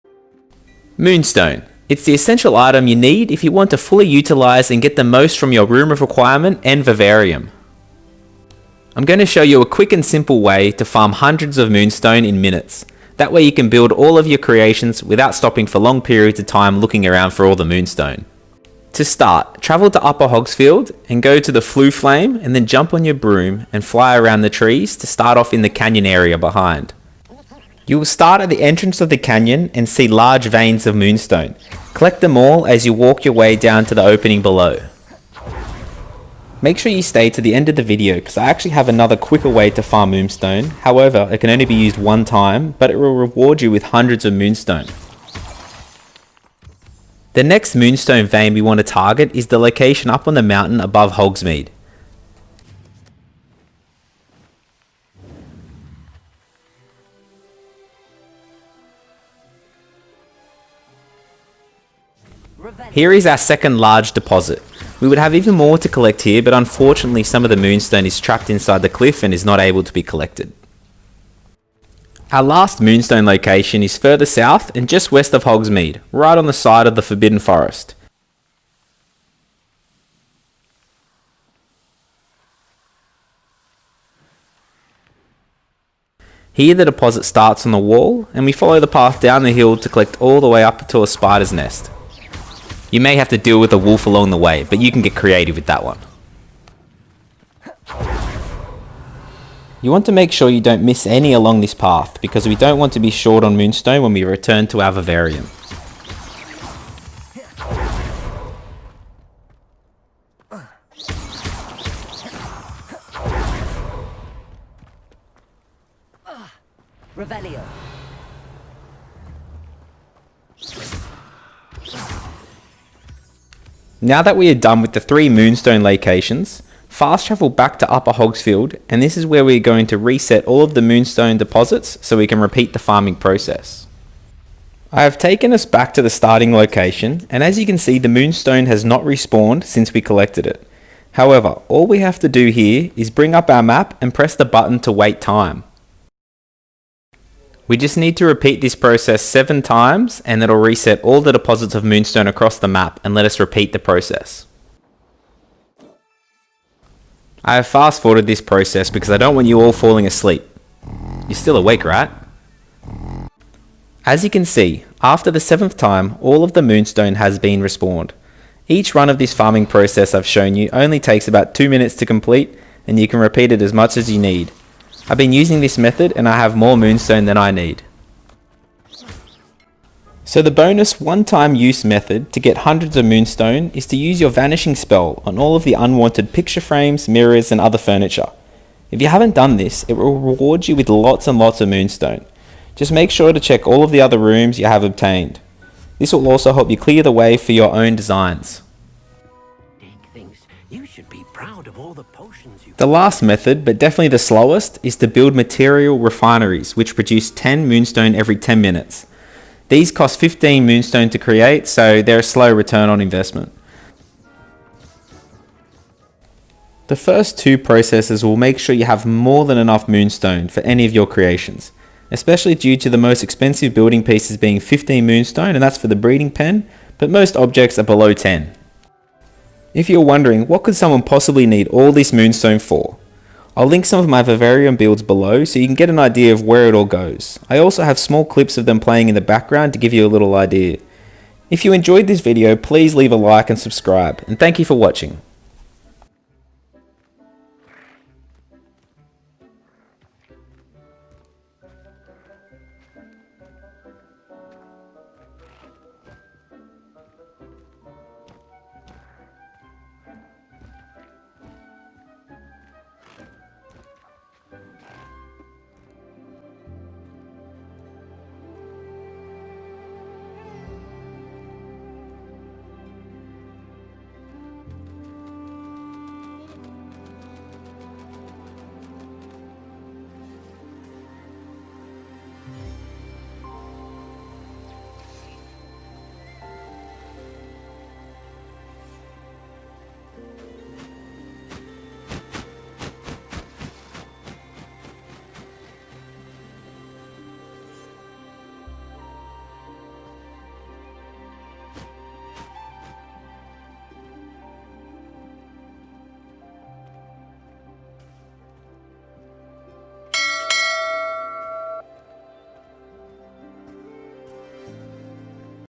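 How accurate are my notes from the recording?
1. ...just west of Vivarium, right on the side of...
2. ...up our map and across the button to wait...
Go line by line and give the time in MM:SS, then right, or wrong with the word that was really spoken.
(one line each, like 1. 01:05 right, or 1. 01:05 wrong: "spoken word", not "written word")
1. 01:14 wrong: "Hogsmeade", not "Vivarium"
2. 02:23 wrong: "press", not "across".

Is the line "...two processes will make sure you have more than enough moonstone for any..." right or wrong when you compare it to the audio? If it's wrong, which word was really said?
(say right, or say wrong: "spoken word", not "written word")
right.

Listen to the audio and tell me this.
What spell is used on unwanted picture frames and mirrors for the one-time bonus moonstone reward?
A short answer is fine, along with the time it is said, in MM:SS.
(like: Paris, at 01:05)
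Vanishing spell, at 03:04.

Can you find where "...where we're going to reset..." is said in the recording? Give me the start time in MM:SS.
02:09.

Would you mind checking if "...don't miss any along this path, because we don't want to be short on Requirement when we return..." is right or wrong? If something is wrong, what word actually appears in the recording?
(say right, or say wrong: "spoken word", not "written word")
wrong: "Moonstone", not "Requirement".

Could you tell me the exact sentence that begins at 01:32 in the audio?
You may have to deal with a wolf along the way, but you can get creative with that one.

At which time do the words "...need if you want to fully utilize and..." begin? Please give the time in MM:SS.
00:02.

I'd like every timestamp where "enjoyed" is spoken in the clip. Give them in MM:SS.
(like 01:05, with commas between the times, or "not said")
04:01.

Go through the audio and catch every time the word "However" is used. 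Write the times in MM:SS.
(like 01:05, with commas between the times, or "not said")
00:40, 02:21.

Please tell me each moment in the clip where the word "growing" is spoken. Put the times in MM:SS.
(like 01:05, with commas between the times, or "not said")
not said.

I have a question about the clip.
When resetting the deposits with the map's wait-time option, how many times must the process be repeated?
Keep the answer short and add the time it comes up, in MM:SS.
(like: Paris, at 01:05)
7, at 02:29.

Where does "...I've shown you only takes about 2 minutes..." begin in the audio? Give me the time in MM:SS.
02:50.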